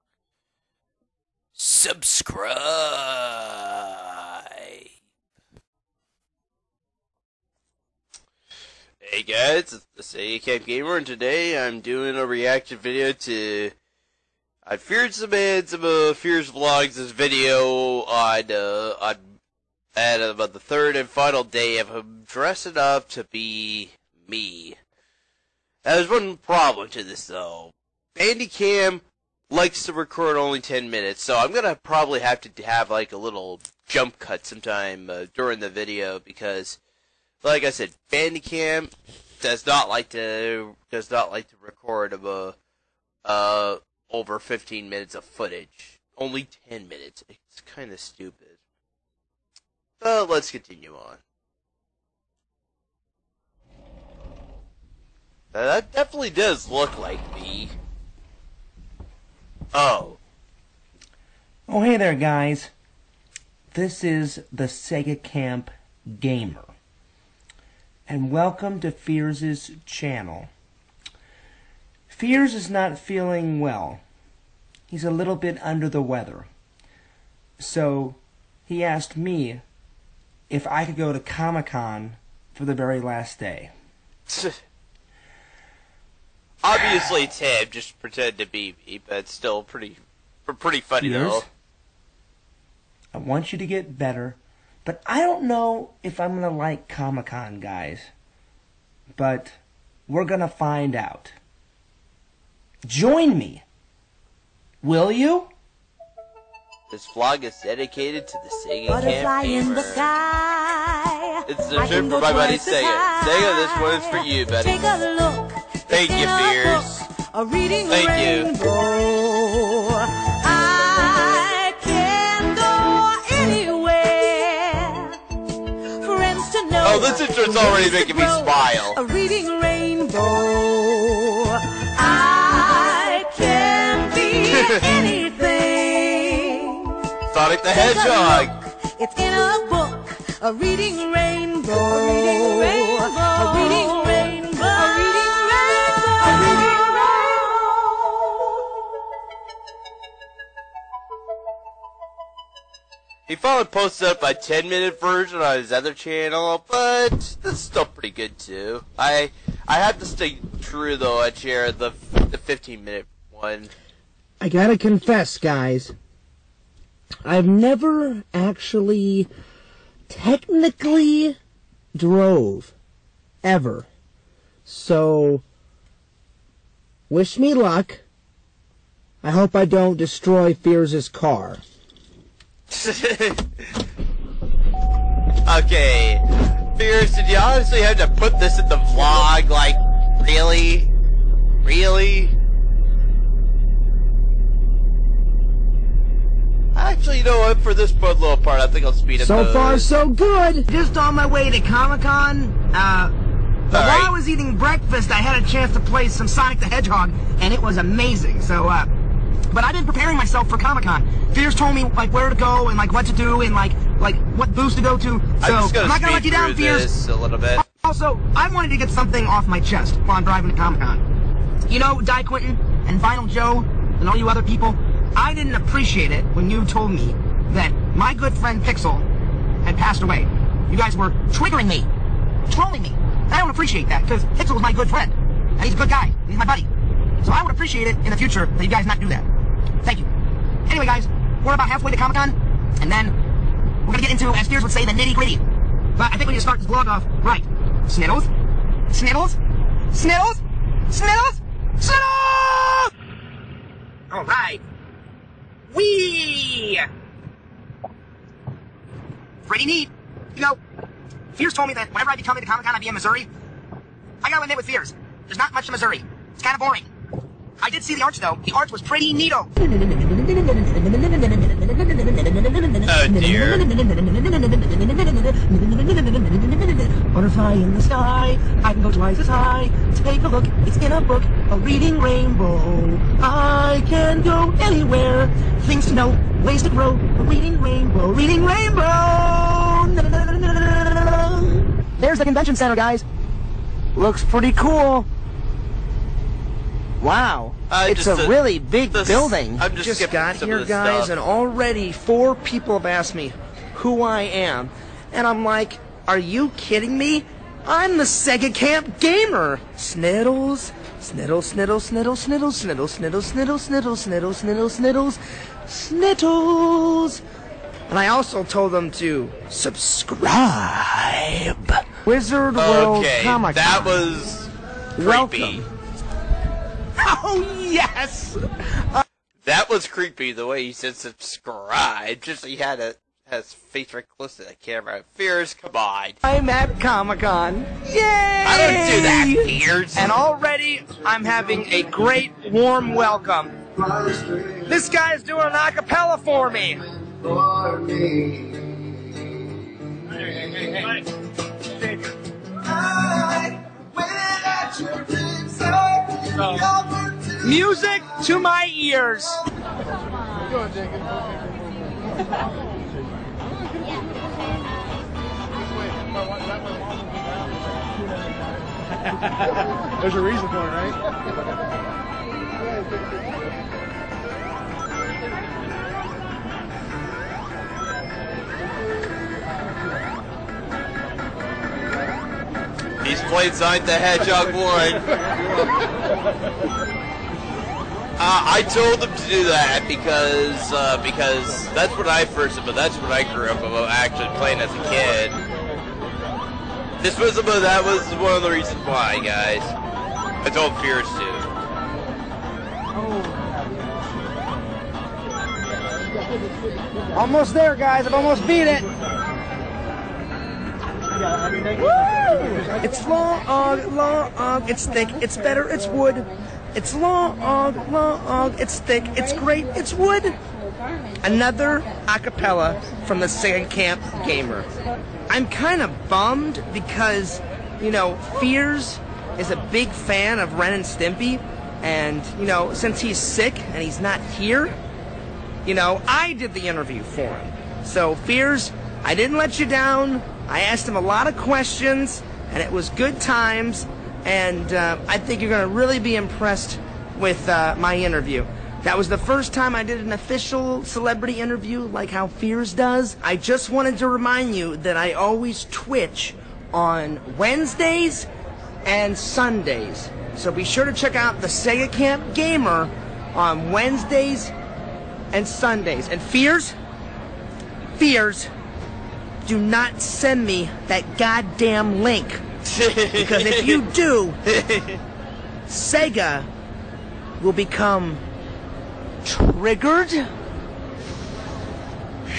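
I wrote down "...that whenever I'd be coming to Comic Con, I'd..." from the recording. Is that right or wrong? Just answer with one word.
right.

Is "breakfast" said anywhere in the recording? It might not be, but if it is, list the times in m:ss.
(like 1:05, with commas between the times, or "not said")
3:24.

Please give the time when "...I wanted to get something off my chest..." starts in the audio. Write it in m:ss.
3:38.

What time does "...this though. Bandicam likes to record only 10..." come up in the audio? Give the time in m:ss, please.
0:27.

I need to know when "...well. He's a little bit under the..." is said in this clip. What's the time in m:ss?
1:13.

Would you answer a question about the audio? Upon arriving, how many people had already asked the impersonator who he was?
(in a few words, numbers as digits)
4.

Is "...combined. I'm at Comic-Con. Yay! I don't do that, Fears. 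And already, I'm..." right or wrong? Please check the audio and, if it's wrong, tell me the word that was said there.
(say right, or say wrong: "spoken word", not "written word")
right.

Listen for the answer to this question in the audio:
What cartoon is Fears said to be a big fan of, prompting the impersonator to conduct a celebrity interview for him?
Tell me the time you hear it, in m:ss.
7:10.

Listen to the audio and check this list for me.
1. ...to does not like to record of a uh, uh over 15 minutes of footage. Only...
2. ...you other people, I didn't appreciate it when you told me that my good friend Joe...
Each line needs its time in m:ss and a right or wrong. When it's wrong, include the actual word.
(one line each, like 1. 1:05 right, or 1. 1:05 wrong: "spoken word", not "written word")
1. 0:40 right
2. 3:44 wrong: "Pixel", not "Joe".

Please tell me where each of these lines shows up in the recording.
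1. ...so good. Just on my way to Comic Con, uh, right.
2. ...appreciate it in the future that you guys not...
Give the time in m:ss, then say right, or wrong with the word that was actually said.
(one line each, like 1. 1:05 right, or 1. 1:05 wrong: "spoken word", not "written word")
1. 3:19 right
2. 3:57 right.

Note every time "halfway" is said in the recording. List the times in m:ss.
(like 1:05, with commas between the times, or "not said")
4:01.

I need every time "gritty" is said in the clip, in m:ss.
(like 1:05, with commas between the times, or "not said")
4:05.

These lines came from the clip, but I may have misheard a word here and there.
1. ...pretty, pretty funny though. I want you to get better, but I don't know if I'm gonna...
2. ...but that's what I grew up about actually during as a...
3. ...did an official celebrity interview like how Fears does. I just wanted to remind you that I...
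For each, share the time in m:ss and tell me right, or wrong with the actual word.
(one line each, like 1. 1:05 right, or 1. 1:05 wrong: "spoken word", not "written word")
1. 1:29 right
2. 6:32 wrong: "playing", not "during"
3. 7:29 right.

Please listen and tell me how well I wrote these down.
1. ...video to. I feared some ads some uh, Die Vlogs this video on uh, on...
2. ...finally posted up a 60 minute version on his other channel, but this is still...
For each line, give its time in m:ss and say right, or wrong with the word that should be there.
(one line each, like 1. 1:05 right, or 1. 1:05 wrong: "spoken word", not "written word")
1. 0:12 wrong: "Fears", not "Die"
2. 2:33 wrong: "10", not "60".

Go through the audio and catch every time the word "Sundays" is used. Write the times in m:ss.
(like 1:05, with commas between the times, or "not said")
7:39, 7:45.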